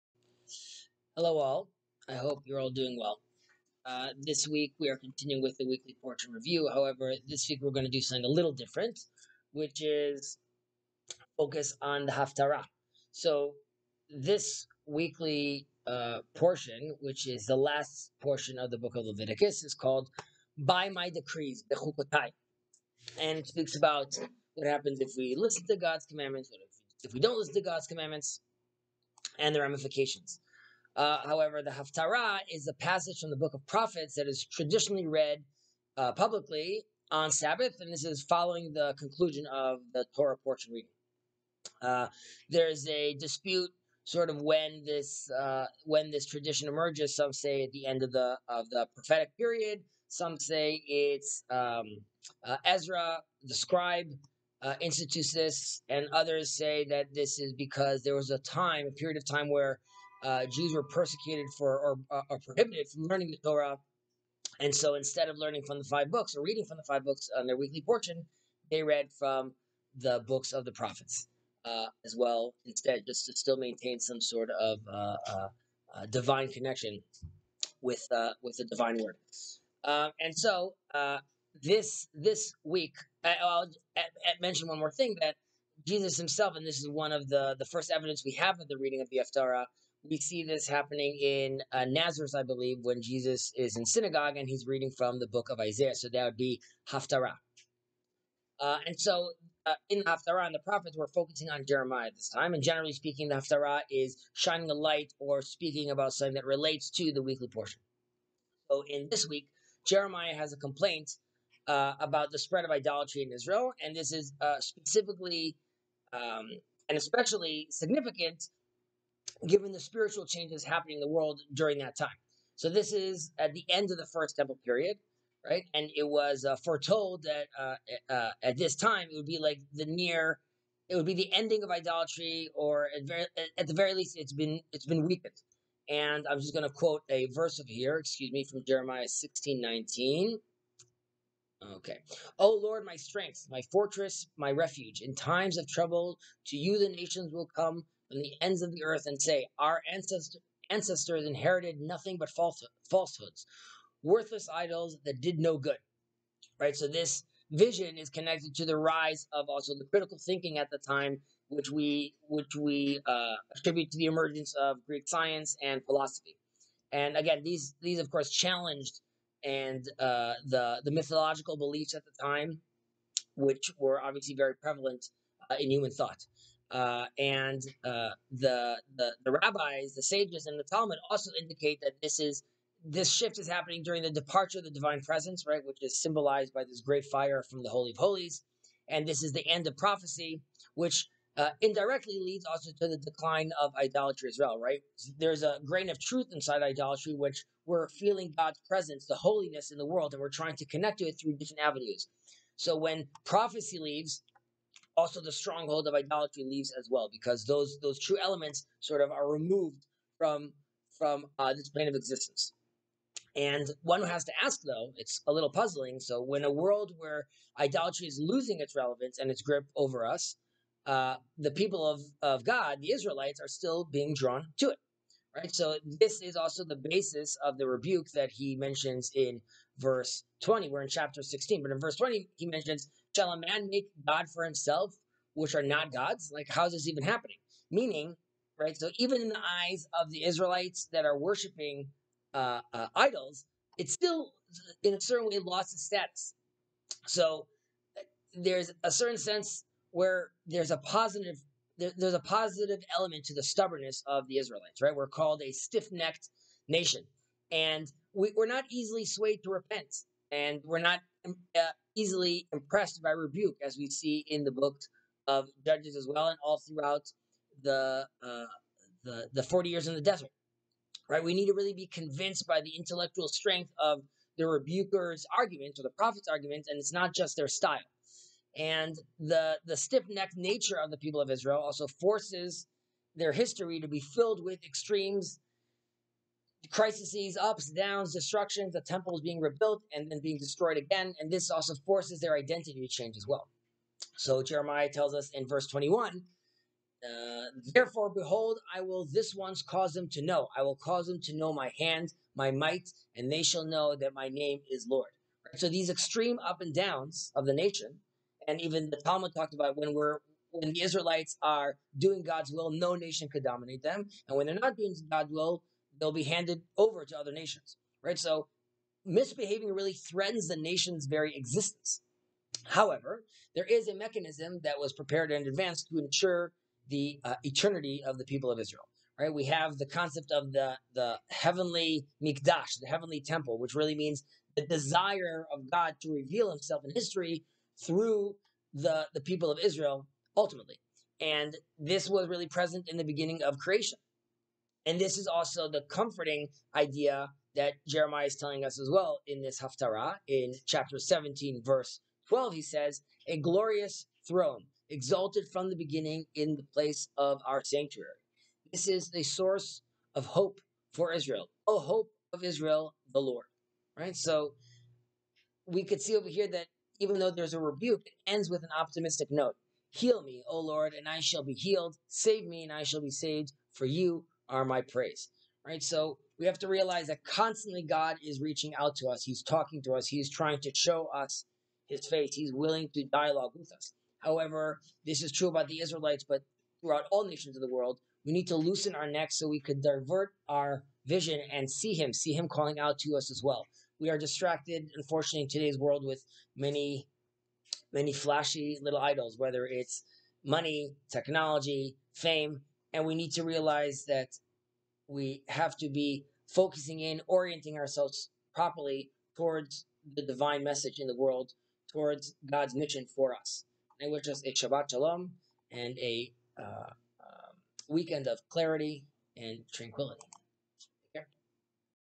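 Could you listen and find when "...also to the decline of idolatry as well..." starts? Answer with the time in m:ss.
3:12.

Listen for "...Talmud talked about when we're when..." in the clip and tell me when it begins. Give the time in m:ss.
5:09.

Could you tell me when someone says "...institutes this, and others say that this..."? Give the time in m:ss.
0:54.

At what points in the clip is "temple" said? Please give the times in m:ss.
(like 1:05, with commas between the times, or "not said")
2:04, 4:48, 5:33.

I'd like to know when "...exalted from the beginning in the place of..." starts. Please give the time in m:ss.
5:54.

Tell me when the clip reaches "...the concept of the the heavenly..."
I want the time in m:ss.
5:29.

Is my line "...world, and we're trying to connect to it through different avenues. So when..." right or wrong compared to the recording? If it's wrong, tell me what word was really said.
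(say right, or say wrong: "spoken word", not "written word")
right.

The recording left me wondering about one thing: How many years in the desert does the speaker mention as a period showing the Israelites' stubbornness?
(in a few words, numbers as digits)
40.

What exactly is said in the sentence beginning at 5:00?
I will cause them to know my hand, my might, and they shall know that my name is Lord.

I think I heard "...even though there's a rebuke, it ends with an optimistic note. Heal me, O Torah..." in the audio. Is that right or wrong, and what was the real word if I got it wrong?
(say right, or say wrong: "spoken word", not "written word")
wrong: "Lord", not "Torah".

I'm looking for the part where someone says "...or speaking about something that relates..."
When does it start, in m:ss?
1:45.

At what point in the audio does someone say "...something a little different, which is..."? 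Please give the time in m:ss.
0:08.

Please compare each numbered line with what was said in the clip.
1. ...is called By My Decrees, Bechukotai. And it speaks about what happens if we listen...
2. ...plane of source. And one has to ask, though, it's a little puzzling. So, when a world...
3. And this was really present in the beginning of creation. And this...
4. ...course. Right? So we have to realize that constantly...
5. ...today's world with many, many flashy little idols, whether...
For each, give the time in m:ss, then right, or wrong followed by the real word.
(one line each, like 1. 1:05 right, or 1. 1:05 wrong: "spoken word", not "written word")
1. 0:19 right
2. 3:31 wrong: "existence", not "source"
3. 5:41 right
4. 6:14 wrong: "praise", not "course"
5. 6:35 right.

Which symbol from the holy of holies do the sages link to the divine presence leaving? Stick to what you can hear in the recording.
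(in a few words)
Great fire.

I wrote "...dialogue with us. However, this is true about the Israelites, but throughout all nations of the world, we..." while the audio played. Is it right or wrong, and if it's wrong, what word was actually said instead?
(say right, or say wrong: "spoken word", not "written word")
right.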